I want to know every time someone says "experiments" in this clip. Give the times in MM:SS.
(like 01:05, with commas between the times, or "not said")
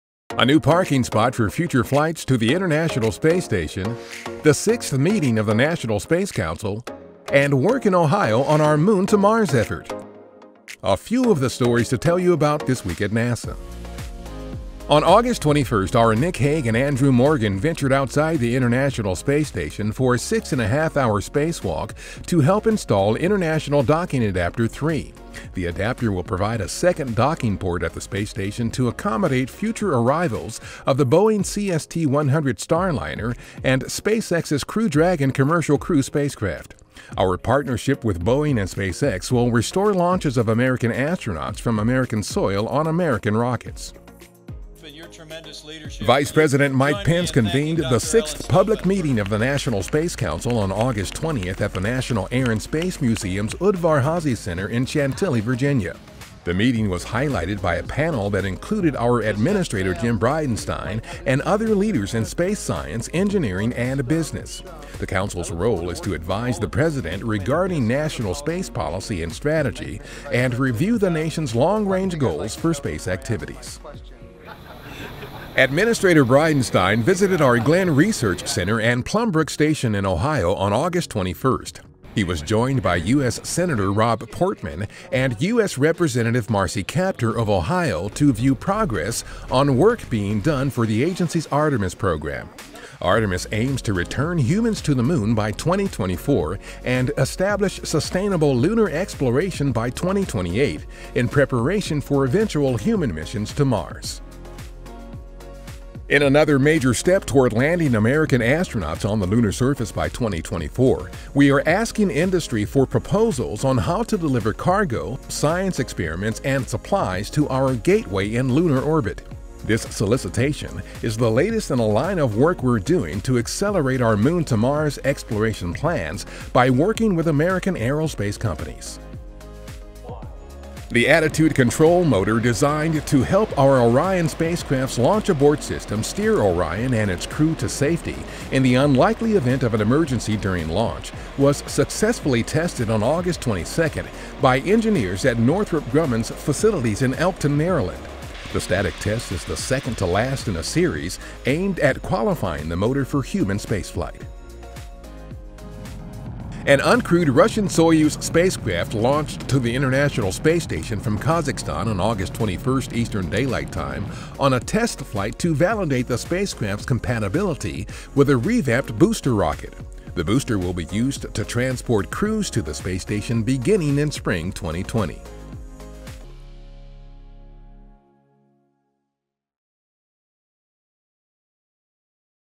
01:55.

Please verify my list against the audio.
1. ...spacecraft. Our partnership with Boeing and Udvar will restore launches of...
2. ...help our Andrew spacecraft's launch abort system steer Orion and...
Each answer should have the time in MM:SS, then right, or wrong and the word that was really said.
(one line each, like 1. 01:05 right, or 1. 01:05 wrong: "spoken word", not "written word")
1. 00:36 wrong: "SpaceX", not "Udvar"
2. 02:13 wrong: "Orion", not "Andrew".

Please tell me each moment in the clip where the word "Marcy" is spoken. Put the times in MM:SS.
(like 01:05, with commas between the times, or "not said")
01:26.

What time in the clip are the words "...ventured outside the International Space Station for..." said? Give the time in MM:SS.
00:17.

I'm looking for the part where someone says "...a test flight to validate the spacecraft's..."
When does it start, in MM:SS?
02:44.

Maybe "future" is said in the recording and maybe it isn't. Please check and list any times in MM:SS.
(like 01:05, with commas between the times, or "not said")
00:01, 00:29.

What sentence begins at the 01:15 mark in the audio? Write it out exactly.
Administrator Bridenstine visited our Glenn Research Center and Plumbrook Station in Ohio on August 21st.